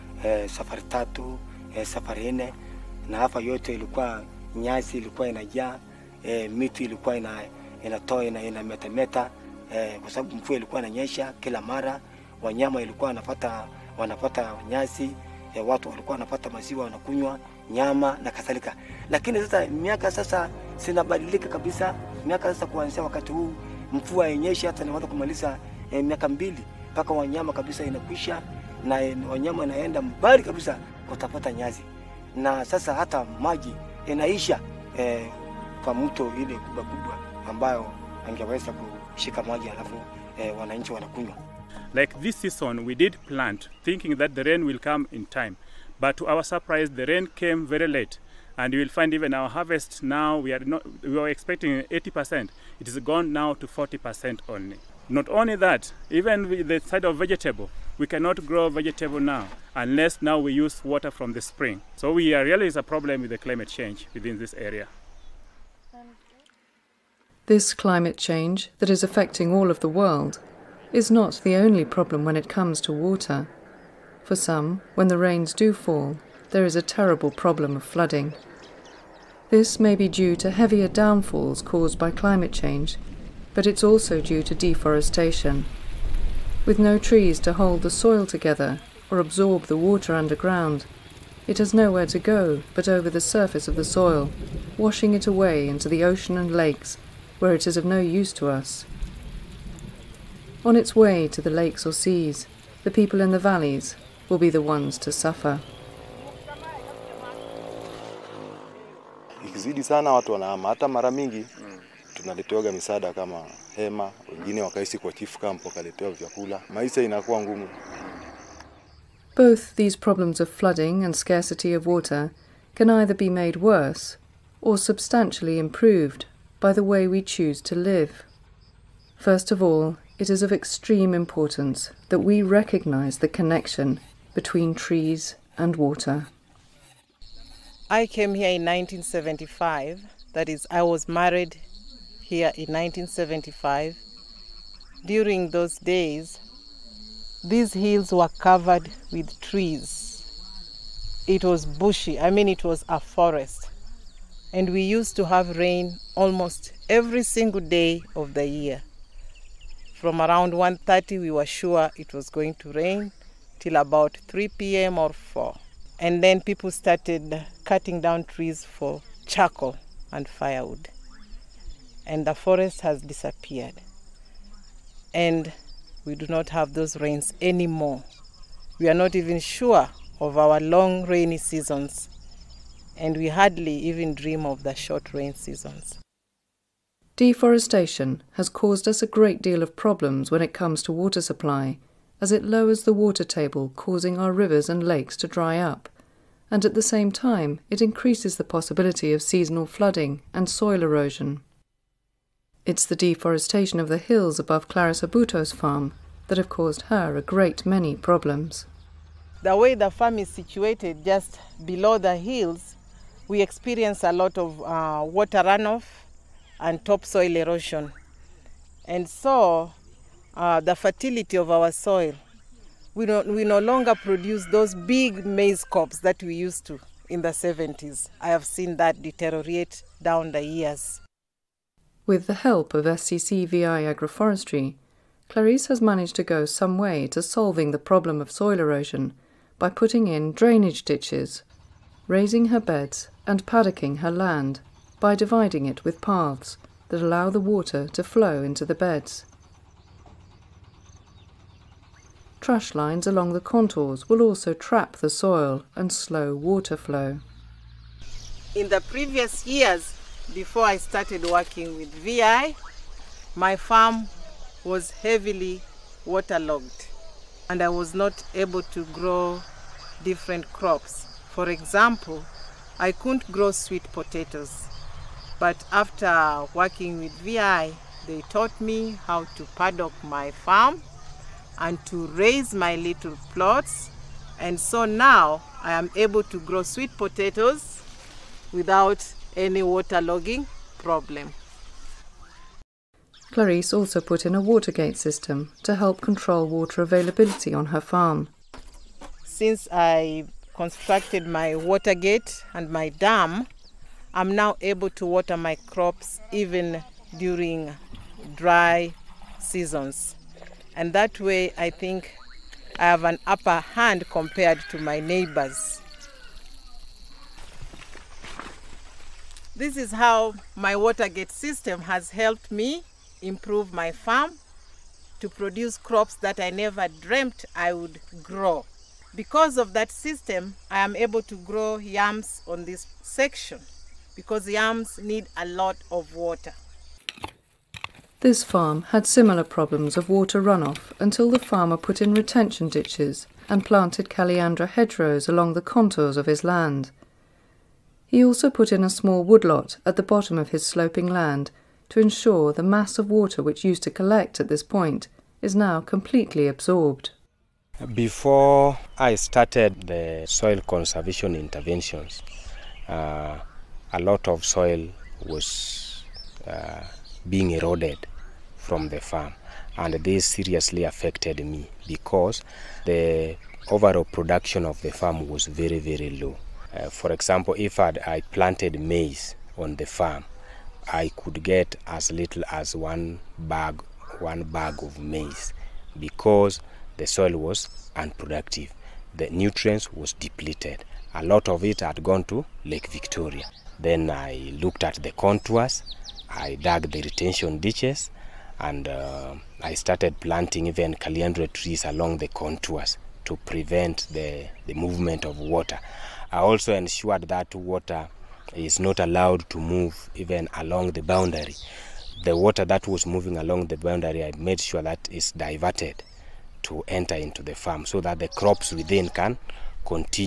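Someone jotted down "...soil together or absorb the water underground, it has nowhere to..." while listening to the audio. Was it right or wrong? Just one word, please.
right.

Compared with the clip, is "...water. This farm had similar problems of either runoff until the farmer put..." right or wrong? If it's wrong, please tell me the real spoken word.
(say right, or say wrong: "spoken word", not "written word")
wrong: "water", not "either".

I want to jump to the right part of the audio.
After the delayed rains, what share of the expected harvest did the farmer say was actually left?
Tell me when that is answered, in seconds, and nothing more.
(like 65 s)
53 s.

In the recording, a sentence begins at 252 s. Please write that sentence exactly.
Trash lines along the contours will also trap the soil and slow water flow.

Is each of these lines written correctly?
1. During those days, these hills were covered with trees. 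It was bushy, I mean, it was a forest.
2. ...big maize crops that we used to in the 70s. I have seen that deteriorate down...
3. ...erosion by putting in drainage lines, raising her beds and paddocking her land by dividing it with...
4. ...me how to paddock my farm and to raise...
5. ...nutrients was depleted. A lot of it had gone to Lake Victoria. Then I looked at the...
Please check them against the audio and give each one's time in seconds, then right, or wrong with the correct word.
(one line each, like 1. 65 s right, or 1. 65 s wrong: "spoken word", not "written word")
1. 145 s right
2. 224 s right
3. 238 s wrong: "ditches", not "lines"
4. 278 s right
5. 389 s right.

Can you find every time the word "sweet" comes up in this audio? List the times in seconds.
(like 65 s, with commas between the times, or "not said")
273 s, 286 s.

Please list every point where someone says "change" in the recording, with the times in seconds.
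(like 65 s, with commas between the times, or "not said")
63 s, 68 s, 82 s.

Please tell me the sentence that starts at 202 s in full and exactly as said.
It's the deforestation of the hills above Clarissa Buto's farm that have caused her a great many problems.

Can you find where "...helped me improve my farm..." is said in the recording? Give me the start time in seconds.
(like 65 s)
322 s.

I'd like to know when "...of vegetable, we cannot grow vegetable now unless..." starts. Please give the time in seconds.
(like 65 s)
57 s.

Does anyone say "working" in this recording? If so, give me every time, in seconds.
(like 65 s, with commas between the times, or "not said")
261 s, 276 s.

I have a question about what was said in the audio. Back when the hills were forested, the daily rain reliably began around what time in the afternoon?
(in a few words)
1:30.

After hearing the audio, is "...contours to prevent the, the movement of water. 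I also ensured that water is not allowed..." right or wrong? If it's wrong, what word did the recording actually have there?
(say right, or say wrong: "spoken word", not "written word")
right.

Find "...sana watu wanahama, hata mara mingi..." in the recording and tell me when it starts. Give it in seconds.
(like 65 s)
109 s.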